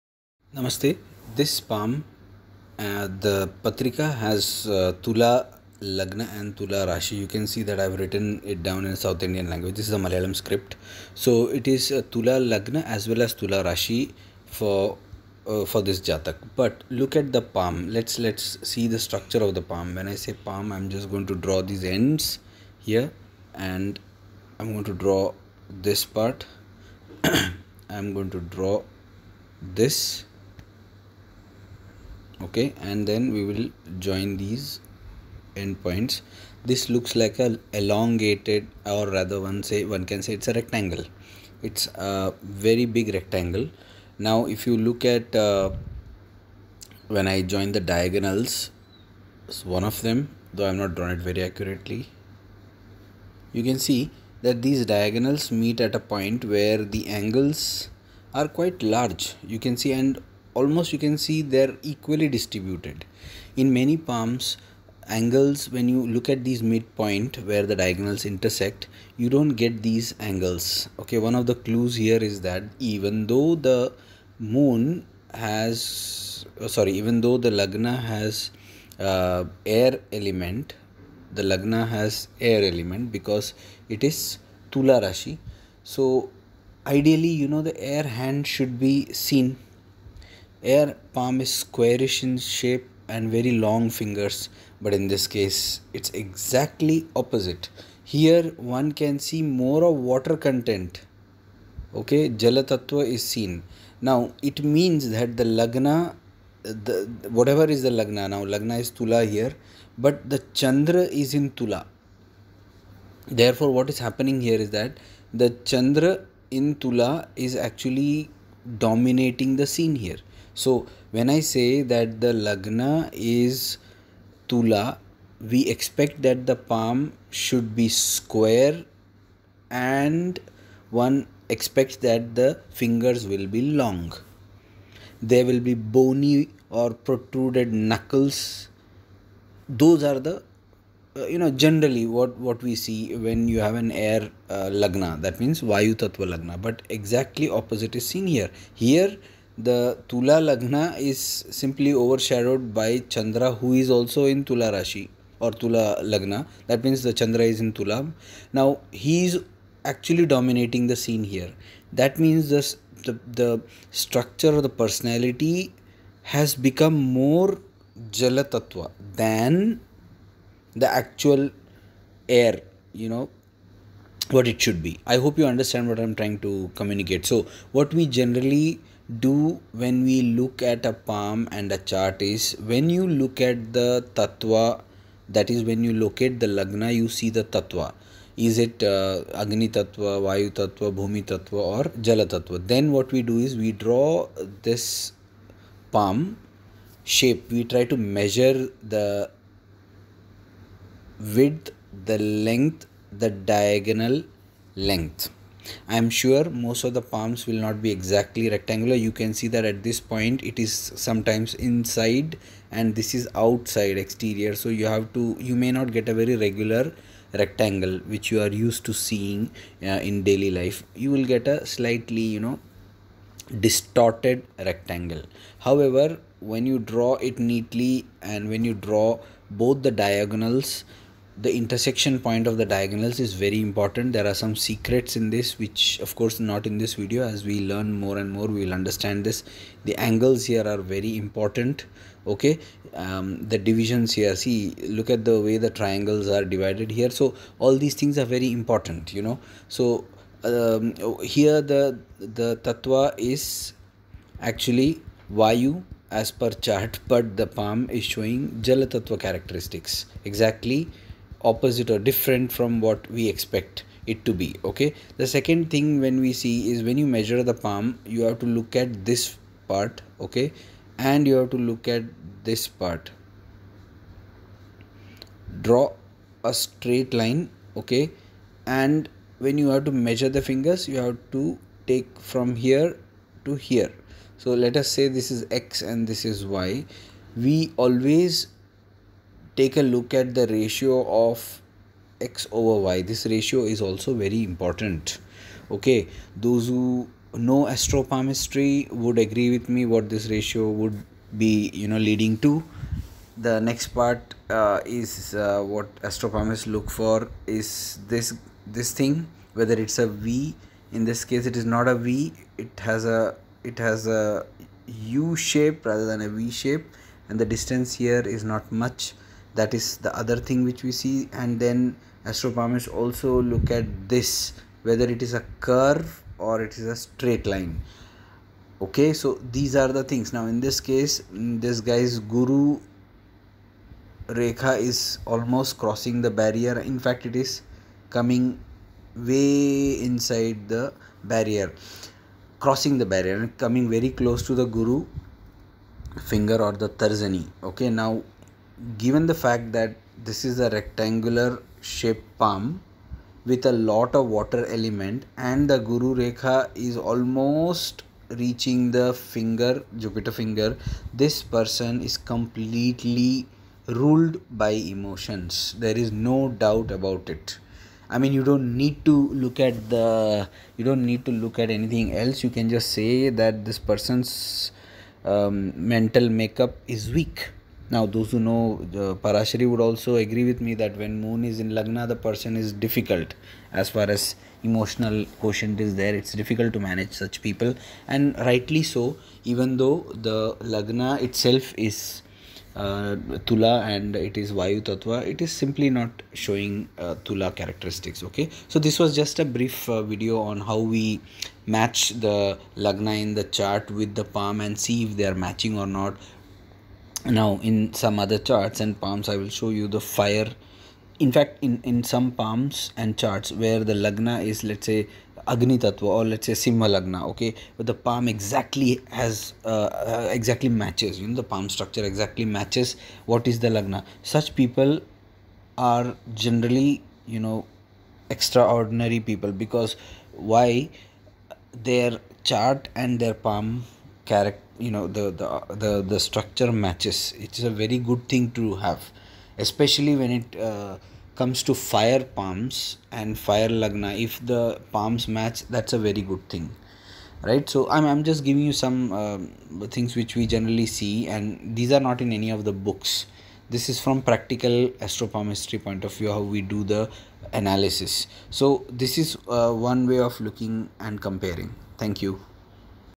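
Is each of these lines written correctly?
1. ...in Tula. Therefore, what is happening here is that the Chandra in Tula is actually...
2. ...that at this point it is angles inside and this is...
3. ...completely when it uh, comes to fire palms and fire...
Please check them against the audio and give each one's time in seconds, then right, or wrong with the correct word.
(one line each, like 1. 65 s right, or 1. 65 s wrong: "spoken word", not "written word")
1. 111 s right
2. 209 s wrong: "sometimes", not "angles"
3. 439 s wrong: "especially", not "completely".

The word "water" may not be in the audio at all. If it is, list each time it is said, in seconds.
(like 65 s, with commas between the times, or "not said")
99 s, 354 s.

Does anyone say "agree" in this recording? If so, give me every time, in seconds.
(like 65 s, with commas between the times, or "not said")
299 s, 380 s.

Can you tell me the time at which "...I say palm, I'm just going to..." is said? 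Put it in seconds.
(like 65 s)
20 s.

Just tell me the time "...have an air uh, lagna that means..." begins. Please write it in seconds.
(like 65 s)
143 s.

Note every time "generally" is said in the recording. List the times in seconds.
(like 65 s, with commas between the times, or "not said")
141 s, 178 s, 426 s, 450 s.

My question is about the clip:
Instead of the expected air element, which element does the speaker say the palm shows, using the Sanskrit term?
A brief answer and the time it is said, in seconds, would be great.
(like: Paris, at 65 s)
Jalatattva, at 102 s.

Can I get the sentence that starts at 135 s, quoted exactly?
There will be bony or protruded knuckles.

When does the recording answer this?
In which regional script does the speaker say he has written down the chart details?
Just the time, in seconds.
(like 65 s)
9 s.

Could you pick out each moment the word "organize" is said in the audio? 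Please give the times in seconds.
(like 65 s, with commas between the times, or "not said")
not said.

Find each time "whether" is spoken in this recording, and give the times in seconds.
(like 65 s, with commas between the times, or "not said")
309 s, 324 s.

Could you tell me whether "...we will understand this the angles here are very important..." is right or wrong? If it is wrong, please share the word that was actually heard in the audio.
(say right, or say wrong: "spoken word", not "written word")
right.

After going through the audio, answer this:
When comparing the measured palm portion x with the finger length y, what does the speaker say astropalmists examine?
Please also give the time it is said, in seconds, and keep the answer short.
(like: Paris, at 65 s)
Ratio of x over y, at 290 s.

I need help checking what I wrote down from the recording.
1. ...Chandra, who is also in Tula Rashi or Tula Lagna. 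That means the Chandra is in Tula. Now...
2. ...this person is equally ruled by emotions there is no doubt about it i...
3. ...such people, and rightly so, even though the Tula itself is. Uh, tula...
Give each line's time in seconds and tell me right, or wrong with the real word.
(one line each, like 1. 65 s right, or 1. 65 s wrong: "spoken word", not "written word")
1. 153 s right
2. 361 s wrong: "completely", not "equally"
3. 387 s wrong: "Lagna", not "Tula".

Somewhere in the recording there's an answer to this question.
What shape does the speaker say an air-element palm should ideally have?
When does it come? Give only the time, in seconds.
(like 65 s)
91 s.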